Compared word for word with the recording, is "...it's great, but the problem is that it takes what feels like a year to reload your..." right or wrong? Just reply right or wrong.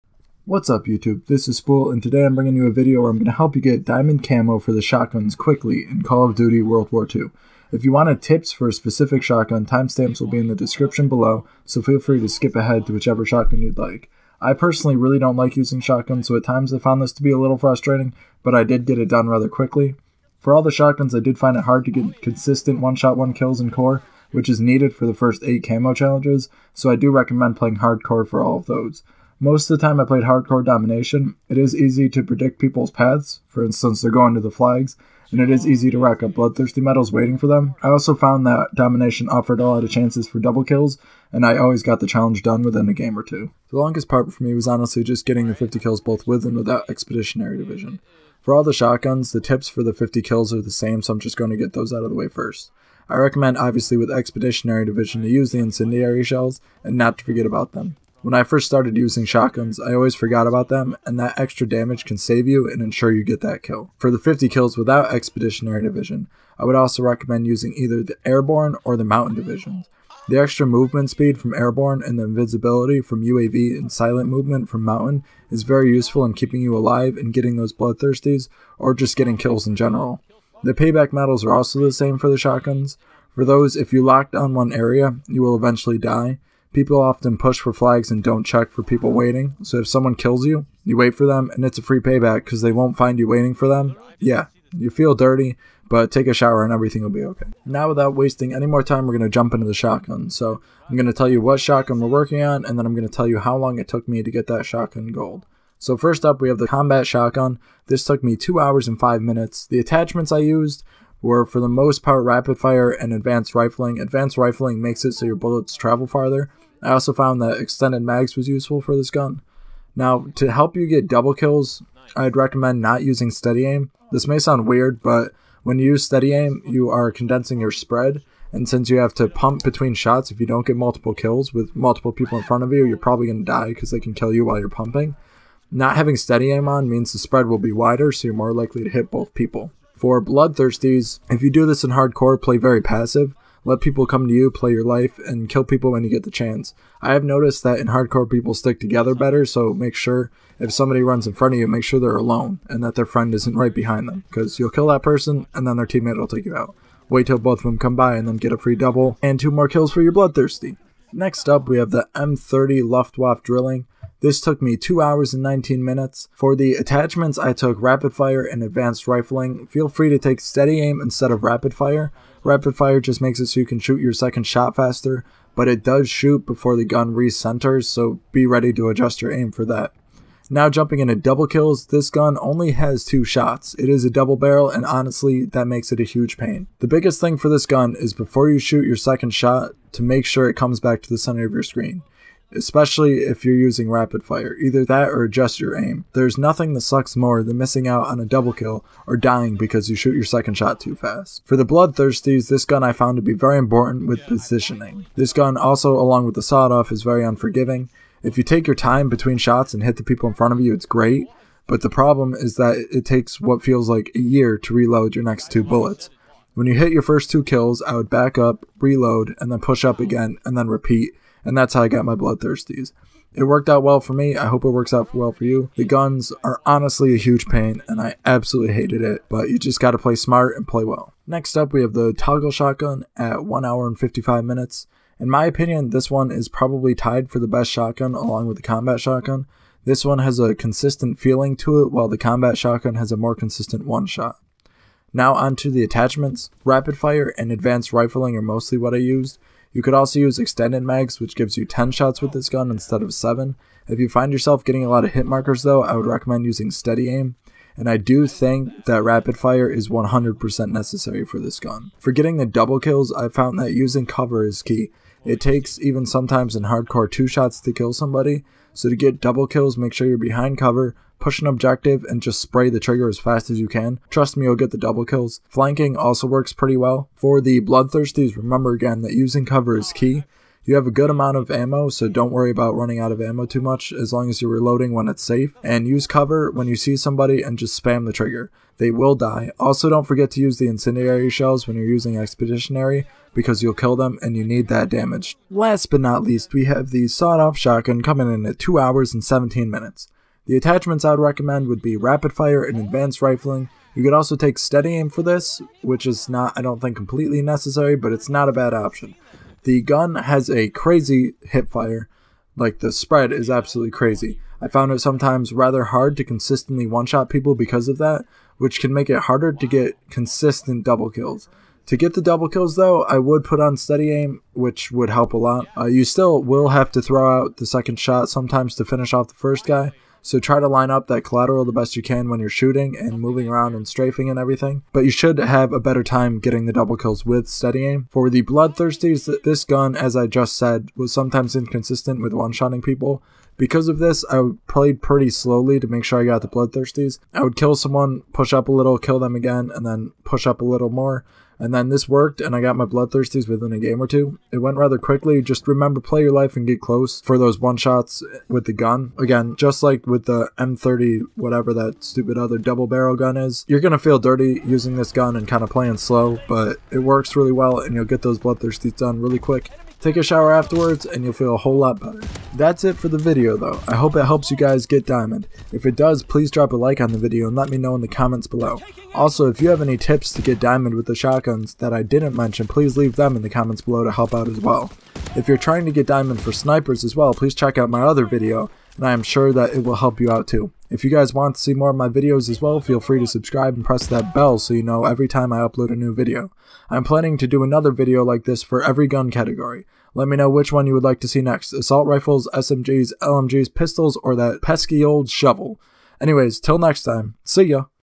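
right.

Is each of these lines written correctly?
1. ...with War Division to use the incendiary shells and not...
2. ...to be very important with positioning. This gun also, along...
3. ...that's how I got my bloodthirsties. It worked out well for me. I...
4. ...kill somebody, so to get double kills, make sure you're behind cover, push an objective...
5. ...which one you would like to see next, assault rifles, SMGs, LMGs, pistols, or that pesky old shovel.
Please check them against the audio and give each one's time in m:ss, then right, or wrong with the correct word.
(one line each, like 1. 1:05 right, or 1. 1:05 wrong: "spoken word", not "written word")
1. 0:53 wrong: "Expeditionary", not "War"
2. 3:23 right
3. 3:41 right
4. 4:27 right
5. 6:40 right.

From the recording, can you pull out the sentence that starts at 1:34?
Yeah, you feel dirty, but take a shower and everything will be okay.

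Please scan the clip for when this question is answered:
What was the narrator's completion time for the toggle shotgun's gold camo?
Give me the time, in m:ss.
3:53.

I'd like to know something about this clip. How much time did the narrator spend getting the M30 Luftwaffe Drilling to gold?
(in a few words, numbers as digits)
2 hours and 19 minutes.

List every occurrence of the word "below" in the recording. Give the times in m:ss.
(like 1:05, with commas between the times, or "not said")
0:11, 6:18, 6:23.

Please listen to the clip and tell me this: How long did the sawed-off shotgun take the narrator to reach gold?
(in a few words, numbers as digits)
2 hours and 17 minutes.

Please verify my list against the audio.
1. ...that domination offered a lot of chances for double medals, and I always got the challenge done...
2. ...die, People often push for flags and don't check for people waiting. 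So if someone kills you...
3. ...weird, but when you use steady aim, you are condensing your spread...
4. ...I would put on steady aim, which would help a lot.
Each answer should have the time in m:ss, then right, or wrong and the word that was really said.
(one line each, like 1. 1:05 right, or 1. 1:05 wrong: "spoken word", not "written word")
1. 0:38 wrong: "kills", not "medals"
2. 1:25 right
3. 2:04 right
4. 5:23 right.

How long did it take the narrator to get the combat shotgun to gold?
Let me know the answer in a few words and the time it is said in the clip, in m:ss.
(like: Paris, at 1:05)
2 hours and 5 minutes, at 1:48.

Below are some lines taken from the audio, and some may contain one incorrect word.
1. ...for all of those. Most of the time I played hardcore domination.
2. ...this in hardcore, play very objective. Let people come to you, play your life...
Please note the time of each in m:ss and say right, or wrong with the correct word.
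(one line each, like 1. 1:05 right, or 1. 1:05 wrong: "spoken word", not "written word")
1. 0:28 right
2. 2:21 wrong: "passive", not "objective".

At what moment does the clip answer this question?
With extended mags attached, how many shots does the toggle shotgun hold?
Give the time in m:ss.
4:11.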